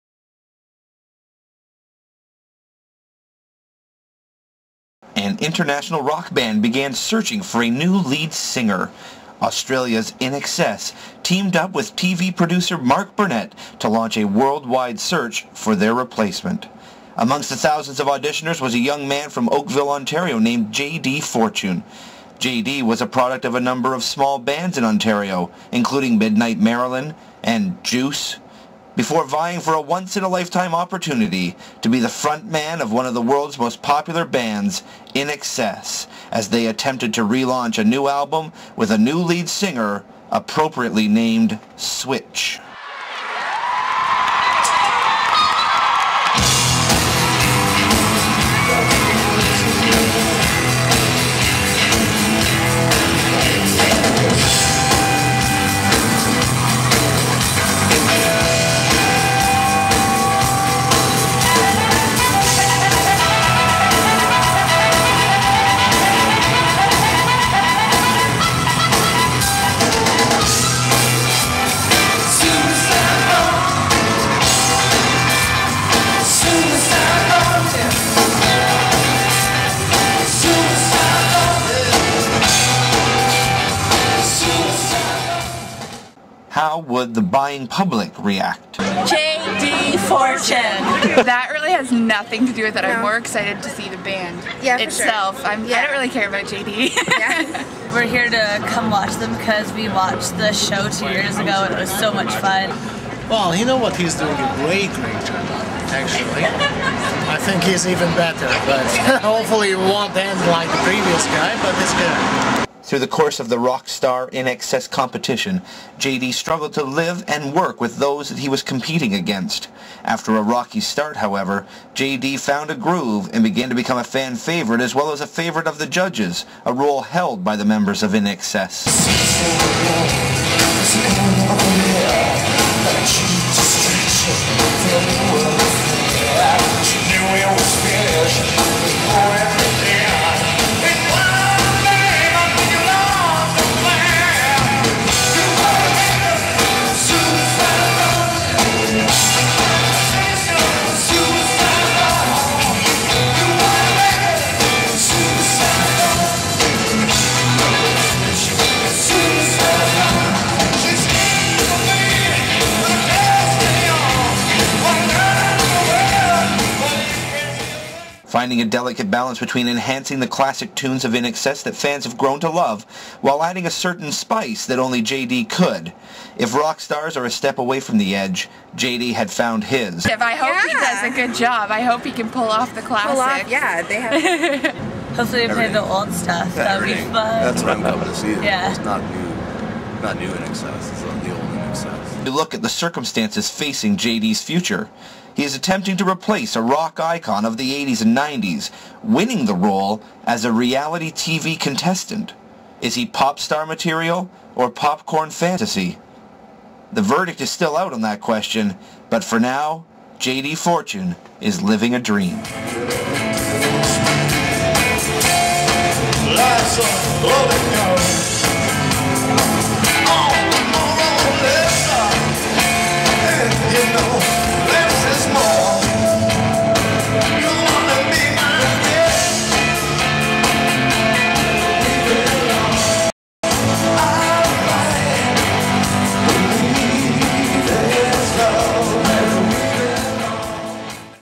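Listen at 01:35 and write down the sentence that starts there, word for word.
I don't really care about J.D.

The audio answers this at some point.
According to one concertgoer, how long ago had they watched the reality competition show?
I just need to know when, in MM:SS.
01:40.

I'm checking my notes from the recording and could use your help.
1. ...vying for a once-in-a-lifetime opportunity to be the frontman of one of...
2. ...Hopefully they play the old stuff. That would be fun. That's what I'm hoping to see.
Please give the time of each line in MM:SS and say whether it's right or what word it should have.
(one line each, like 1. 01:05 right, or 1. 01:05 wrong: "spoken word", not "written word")
1. 00:29 right
2. 03:05 right.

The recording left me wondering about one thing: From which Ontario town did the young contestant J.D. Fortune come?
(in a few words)
Oakville.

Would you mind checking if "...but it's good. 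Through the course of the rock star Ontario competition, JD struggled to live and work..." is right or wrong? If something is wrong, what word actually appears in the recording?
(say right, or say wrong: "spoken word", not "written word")
wrong: "INXS", not "Ontario".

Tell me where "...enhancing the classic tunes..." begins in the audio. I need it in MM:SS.
02:49.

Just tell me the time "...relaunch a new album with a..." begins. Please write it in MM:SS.
00:37.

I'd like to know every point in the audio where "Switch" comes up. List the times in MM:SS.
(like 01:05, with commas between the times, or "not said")
00:41.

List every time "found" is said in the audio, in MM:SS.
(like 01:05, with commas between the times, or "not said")
02:02, 02:59.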